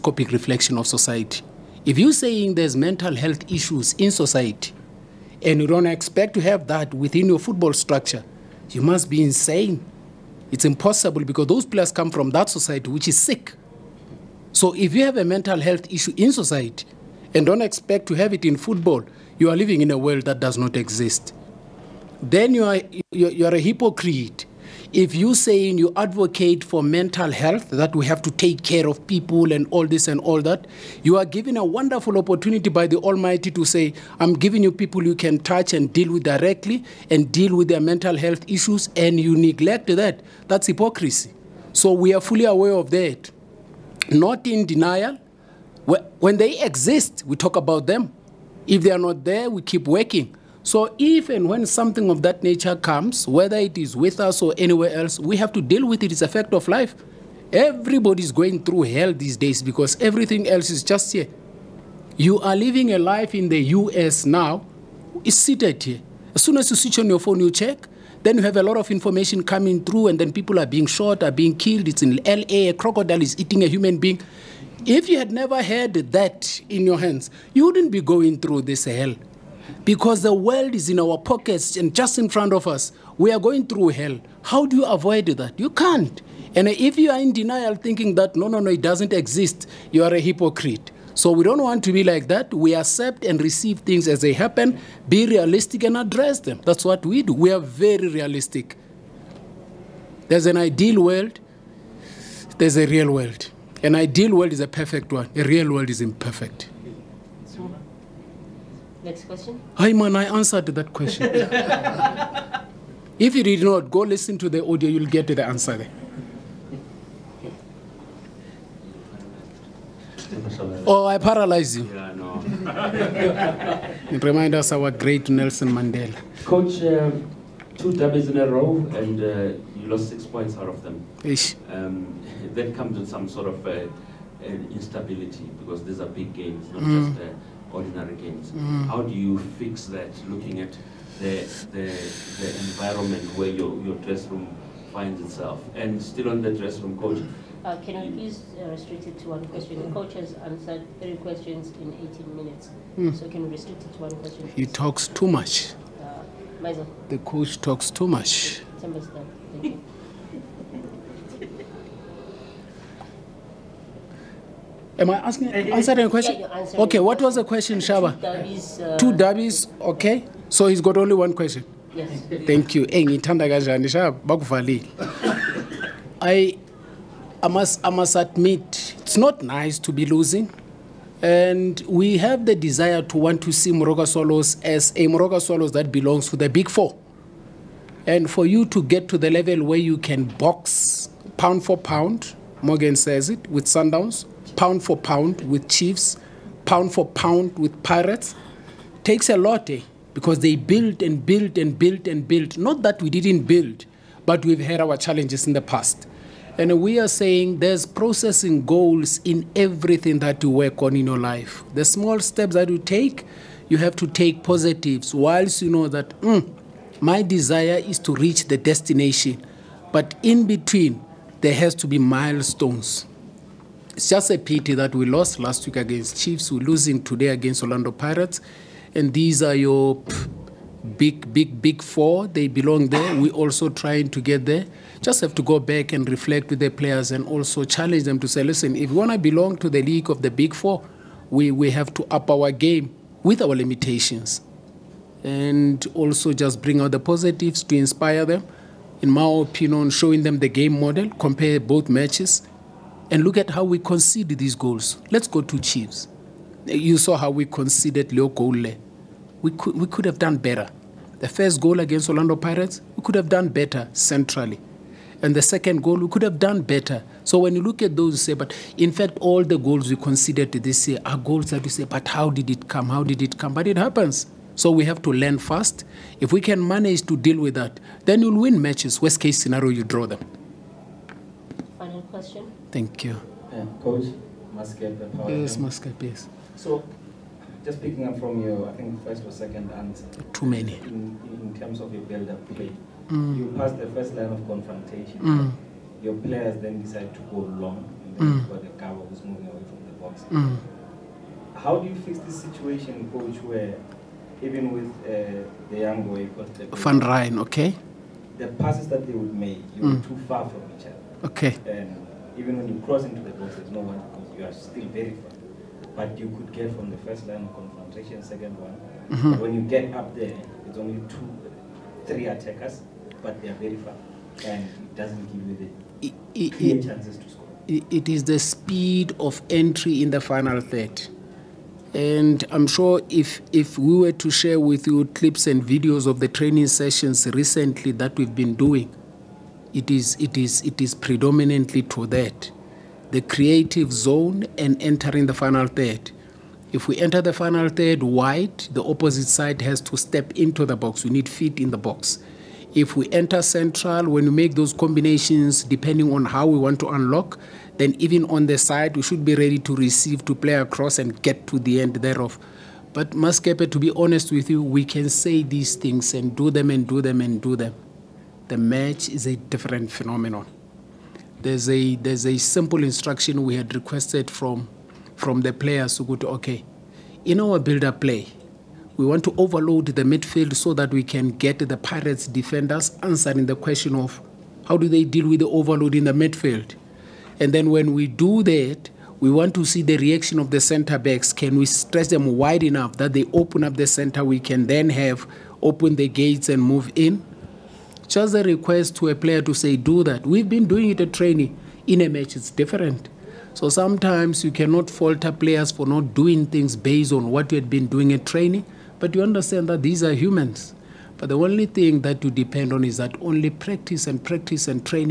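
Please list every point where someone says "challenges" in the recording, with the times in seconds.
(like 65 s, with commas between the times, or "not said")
204 s, 237 s.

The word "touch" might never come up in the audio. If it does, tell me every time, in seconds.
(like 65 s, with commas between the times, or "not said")
35 s.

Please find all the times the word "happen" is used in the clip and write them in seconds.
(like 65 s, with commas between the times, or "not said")
94 s, 273 s.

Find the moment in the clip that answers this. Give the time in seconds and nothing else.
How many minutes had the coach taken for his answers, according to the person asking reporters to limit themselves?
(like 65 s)
152 s.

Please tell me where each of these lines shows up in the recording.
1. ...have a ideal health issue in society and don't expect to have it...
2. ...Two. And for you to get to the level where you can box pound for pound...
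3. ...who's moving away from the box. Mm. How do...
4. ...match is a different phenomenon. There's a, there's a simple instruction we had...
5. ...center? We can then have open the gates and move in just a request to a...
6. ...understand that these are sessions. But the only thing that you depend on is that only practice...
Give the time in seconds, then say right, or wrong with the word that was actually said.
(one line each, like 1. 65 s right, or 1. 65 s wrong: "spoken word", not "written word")
1. 15 s wrong: "mental", not "ideal"
2. 186 s wrong: "Four", not "Two"
3. 299 s right
4. 368 s right
5. 393 s right
6. 409 s wrong: "humans", not "sessions".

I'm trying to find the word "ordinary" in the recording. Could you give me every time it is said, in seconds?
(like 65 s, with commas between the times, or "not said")
137 s.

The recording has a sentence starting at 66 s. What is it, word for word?
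As soon as you switch on your phone, you check.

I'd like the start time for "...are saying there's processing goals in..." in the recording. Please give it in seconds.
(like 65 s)
206 s.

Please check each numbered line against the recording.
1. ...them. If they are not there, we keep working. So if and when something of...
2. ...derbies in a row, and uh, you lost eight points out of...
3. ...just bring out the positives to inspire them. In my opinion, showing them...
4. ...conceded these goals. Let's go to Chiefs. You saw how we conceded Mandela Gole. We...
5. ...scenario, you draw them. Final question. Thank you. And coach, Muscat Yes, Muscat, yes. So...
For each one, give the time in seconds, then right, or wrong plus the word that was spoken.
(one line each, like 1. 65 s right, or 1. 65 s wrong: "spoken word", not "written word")
1. 47 s right
2. 127 s wrong: "six", not "eight"
3. 246 s right
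4. 253 s wrong: "Leo", not "Mandela"
5. 279 s right.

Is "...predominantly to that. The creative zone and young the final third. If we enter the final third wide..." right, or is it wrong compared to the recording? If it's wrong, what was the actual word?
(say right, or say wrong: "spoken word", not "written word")
wrong: "entering", not "young".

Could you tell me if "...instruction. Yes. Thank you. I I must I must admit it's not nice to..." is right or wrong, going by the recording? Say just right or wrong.
wrong.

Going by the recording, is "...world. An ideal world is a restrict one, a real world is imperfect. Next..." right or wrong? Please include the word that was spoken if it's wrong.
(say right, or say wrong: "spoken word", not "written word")
wrong: "perfect", not "restrict".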